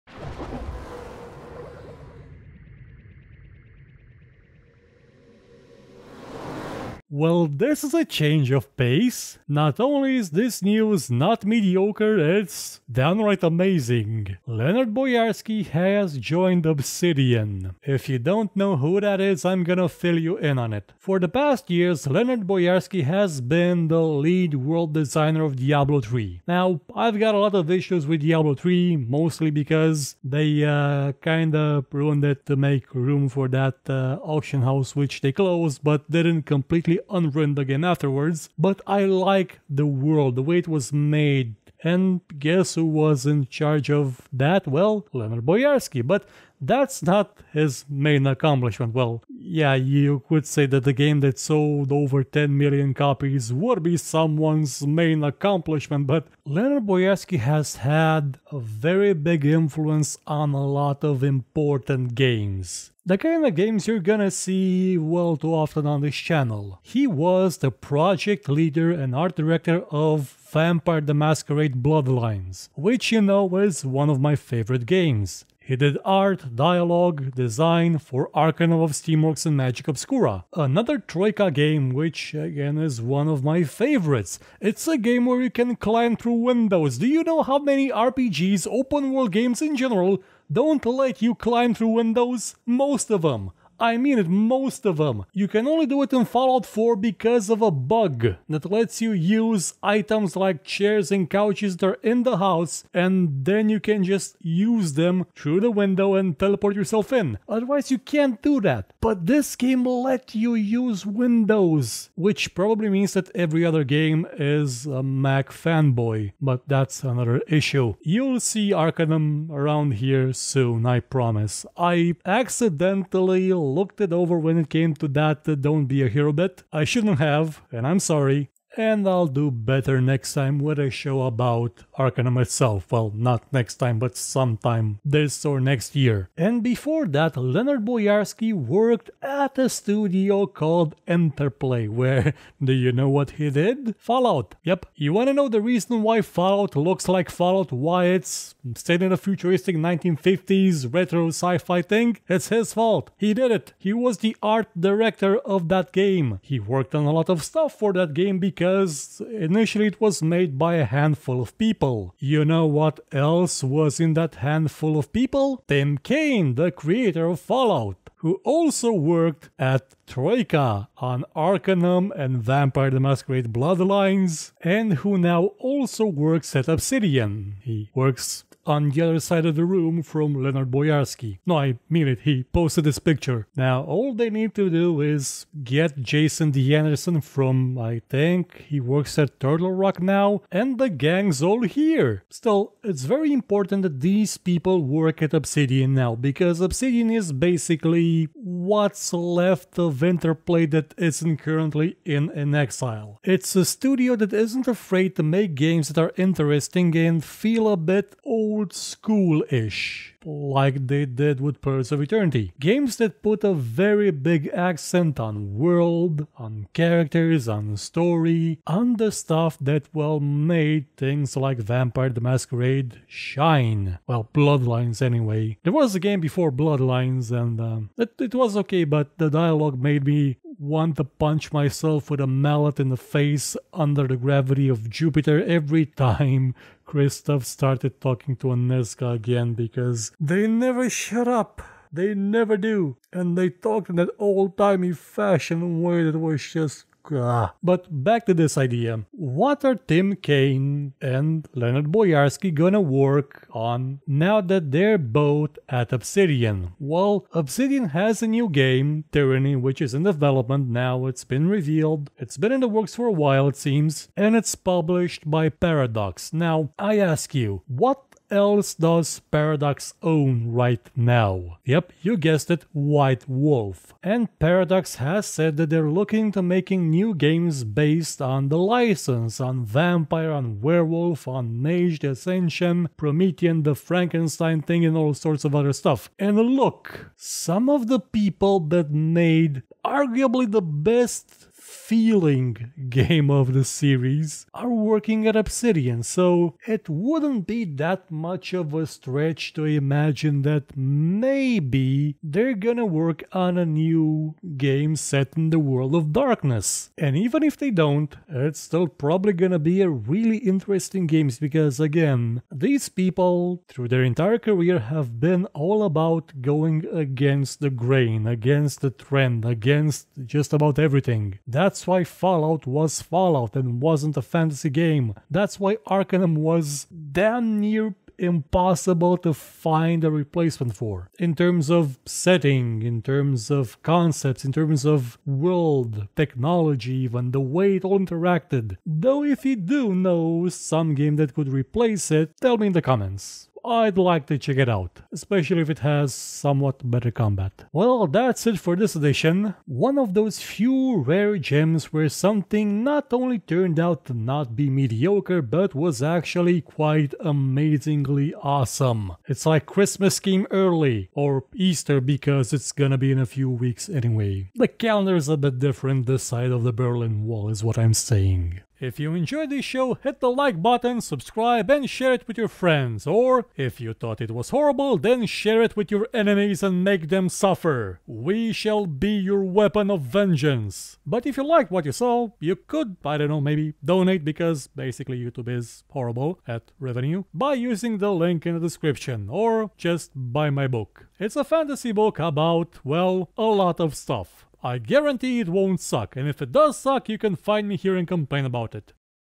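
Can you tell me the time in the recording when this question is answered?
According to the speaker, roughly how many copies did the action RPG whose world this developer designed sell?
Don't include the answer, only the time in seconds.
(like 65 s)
51 s.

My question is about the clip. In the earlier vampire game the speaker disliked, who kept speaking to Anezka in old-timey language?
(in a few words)
Christof.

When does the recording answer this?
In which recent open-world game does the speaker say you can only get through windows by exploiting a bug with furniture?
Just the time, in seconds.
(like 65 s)
96 s.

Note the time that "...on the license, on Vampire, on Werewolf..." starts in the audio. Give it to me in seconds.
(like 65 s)
278 s.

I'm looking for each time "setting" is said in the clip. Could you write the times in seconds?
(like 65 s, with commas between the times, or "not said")
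332 s.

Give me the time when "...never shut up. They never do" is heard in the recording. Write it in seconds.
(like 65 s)
240 s.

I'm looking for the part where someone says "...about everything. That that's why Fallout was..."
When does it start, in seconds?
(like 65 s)
320 s.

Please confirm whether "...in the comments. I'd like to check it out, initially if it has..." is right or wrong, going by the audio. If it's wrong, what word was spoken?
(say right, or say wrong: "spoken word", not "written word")
wrong: "especially", not "initially".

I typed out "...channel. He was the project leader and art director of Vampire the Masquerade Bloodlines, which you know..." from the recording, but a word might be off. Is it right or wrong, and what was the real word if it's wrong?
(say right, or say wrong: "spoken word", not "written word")
right.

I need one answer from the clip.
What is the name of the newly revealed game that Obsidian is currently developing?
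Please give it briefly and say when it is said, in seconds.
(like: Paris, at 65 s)
Tyranny, at 259 s.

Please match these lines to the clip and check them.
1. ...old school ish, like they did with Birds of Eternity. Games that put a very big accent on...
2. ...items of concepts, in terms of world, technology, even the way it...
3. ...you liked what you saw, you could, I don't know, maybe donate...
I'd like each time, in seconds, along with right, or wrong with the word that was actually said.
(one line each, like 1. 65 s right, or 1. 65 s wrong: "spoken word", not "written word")
1. 208 s right
2. 333 s wrong: "terms", not "items"
3. 381 s right.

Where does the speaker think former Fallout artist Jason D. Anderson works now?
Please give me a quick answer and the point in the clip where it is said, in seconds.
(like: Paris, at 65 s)
Turtle Rock, at 189 s.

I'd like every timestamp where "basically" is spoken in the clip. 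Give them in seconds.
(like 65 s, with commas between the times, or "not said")
197 s, 384 s.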